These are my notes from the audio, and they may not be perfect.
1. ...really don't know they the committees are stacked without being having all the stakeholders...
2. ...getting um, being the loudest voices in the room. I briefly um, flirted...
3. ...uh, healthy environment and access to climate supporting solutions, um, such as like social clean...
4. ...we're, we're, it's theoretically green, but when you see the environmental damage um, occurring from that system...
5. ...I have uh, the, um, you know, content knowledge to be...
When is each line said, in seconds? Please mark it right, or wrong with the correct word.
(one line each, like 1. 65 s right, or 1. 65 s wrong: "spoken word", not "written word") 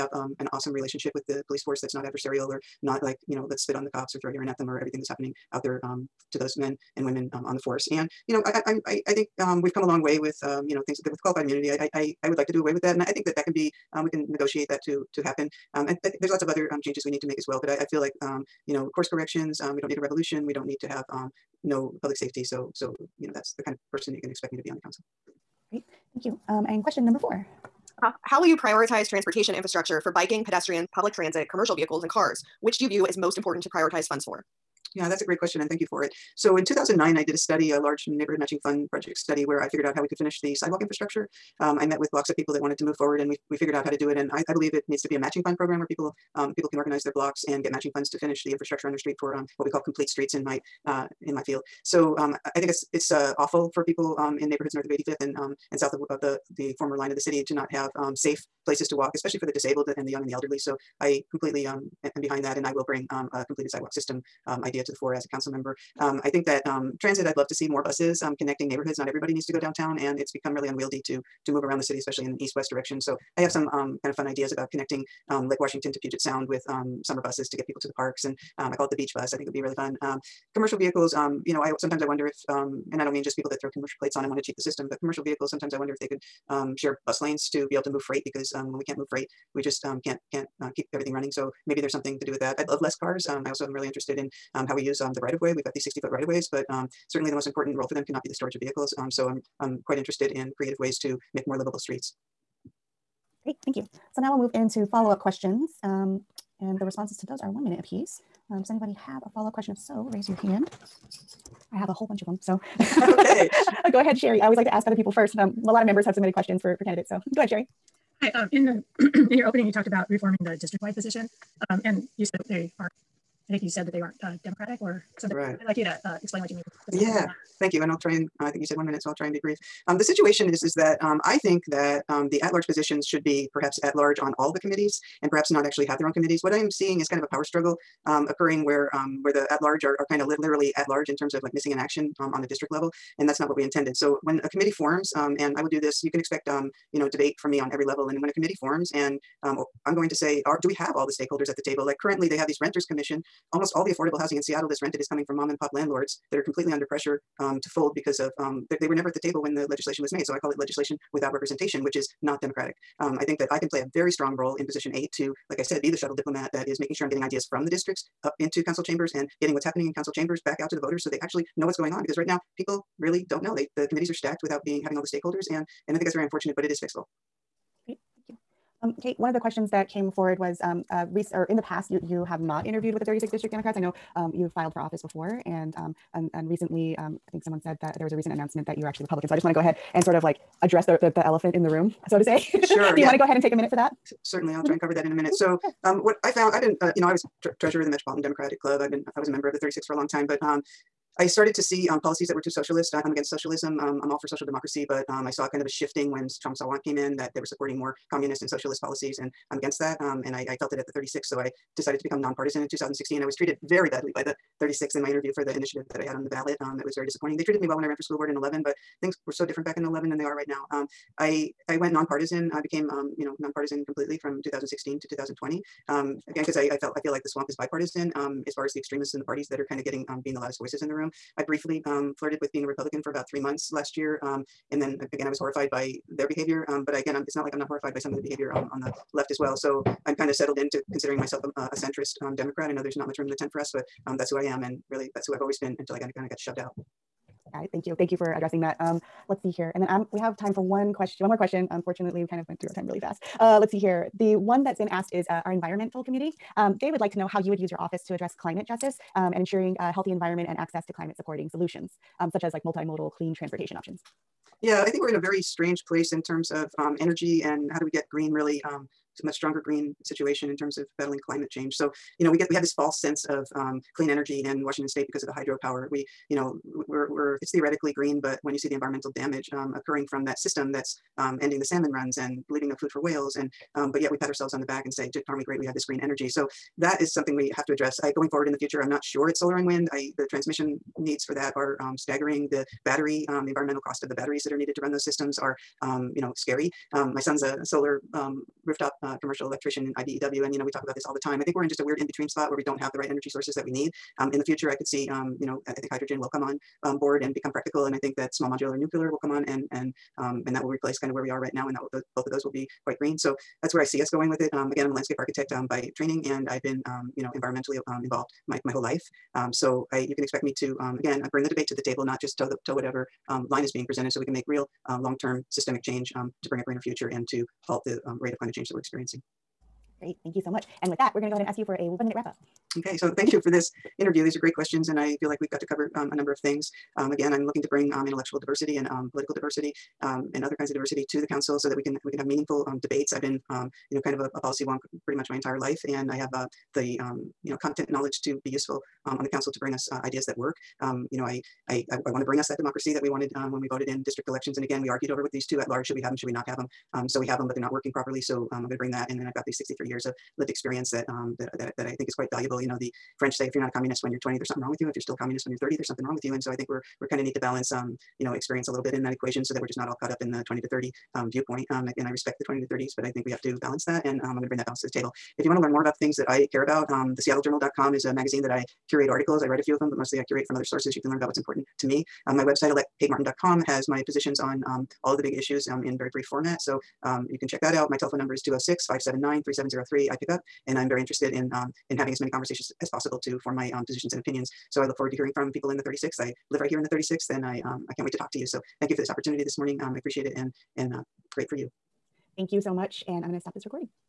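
1. 173 s right
2. 229 s right
3. 259 s wrong: "multimodal", not "social"
4. 276 s right
5. 346 s right.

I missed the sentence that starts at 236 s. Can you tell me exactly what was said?
Um, but I, again, I'm, it's not like I'm not horrified by some of the behavior on, on the left as well.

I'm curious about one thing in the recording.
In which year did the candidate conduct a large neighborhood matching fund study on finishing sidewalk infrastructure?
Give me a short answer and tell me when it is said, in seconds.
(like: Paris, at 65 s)
2009, at 36 s.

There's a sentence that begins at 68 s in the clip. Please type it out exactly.
Not everybody needs to go downtown, and it's become really unwieldy to to move around the city, especially in an east-west direction.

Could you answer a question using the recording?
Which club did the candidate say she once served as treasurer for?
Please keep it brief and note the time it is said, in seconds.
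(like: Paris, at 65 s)
Metropolitan Democratic Club, at 197 s.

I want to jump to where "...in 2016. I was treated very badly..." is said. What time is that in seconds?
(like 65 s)
212 s.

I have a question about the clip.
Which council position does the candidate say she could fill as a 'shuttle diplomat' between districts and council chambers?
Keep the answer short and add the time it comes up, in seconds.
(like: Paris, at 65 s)
position eight, at 164 s.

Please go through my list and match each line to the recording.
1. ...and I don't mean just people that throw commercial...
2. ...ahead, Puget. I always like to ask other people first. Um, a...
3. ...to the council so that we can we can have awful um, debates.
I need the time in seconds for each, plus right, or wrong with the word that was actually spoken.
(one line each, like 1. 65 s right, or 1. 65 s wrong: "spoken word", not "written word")
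1. 82 s right
2. 113 s wrong: "Sherry", not "Puget"
3. 341 s wrong: "meaningful", not "awful".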